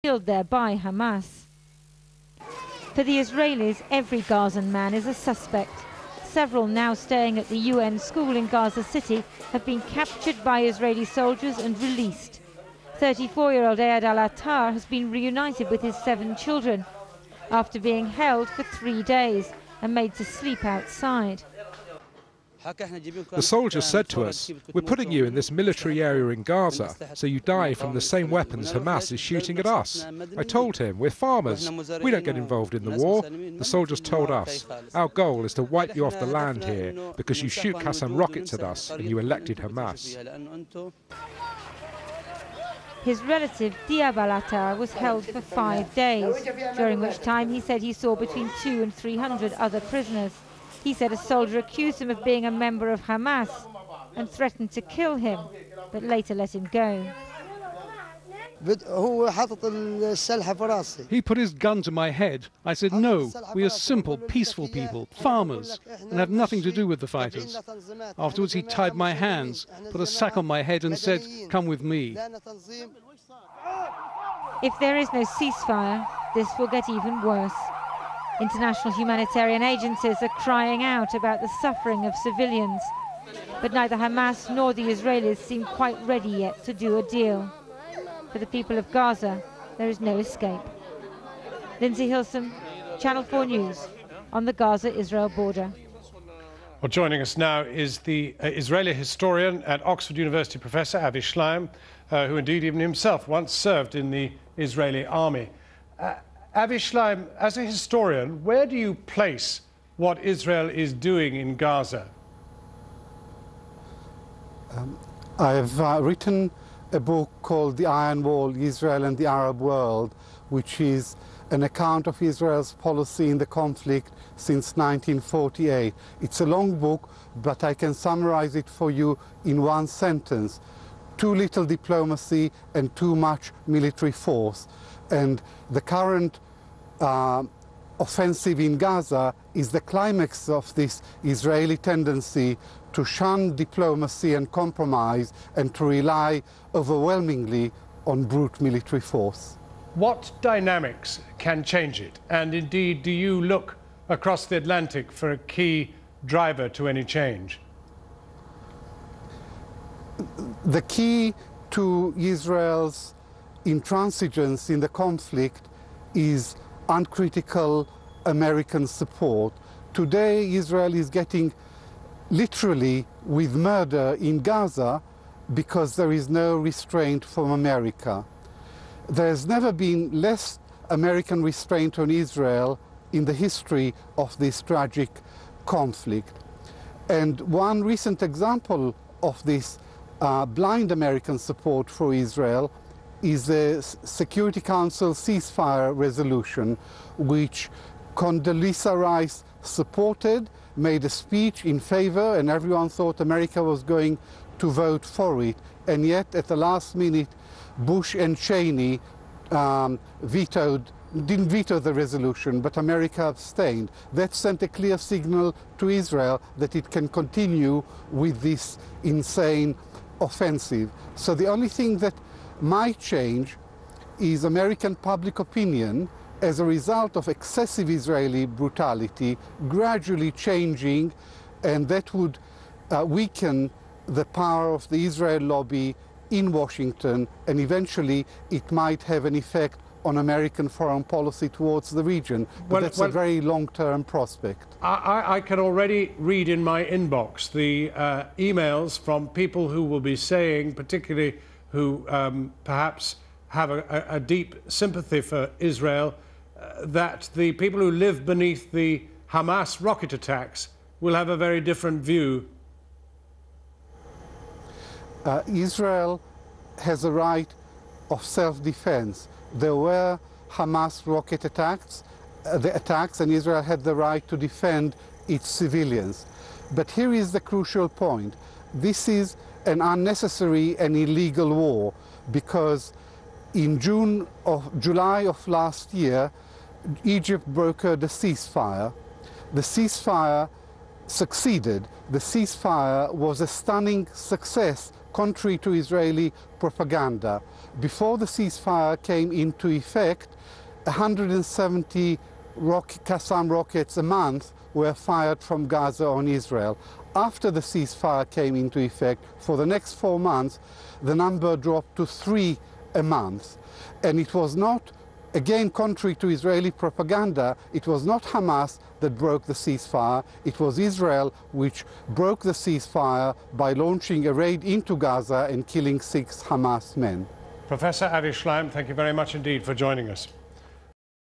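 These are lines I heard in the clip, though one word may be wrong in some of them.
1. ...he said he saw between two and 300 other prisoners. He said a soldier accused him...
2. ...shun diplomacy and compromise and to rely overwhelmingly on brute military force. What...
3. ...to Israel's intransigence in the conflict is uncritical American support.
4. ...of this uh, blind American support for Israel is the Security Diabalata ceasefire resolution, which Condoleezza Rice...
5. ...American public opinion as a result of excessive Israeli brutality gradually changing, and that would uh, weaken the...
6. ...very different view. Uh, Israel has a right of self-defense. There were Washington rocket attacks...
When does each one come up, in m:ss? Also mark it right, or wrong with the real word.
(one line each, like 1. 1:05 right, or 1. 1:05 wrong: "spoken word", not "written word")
1. 0:47 right
2. 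2:23 right
3. 2:41 right
4. 3:09 wrong: "Council", not "Diabalata"
5. 3:44 right
6. 4:21 wrong: "Hamas", not "Washington".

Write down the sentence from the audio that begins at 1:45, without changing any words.
Uh, Avi Shlaim, as a historian, where do you place what Israel is doing in Gaza?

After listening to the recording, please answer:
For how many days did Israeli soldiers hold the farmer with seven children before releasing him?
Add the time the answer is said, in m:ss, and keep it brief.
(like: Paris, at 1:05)
3, at 0:18.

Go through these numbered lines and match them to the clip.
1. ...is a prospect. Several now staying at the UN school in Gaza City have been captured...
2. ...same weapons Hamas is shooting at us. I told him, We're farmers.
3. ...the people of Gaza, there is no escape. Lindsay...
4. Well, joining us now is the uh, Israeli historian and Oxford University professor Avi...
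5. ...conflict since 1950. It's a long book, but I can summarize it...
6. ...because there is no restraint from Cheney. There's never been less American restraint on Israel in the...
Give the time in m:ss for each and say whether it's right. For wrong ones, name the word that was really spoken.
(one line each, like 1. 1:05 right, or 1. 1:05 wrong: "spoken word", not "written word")
1. 0:04 wrong: "suspect", not "prospect"
2. 0:28 right
3. 1:28 right
4. 1:36 right
5. 2:03 wrong: "1948", not "1950"
6. 2:55 wrong: "America", not "Cheney".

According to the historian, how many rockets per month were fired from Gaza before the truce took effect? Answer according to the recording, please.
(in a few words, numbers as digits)
170.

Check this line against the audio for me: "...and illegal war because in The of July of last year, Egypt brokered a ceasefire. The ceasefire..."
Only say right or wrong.
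wrong.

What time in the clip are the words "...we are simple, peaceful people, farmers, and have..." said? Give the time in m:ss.
1:03.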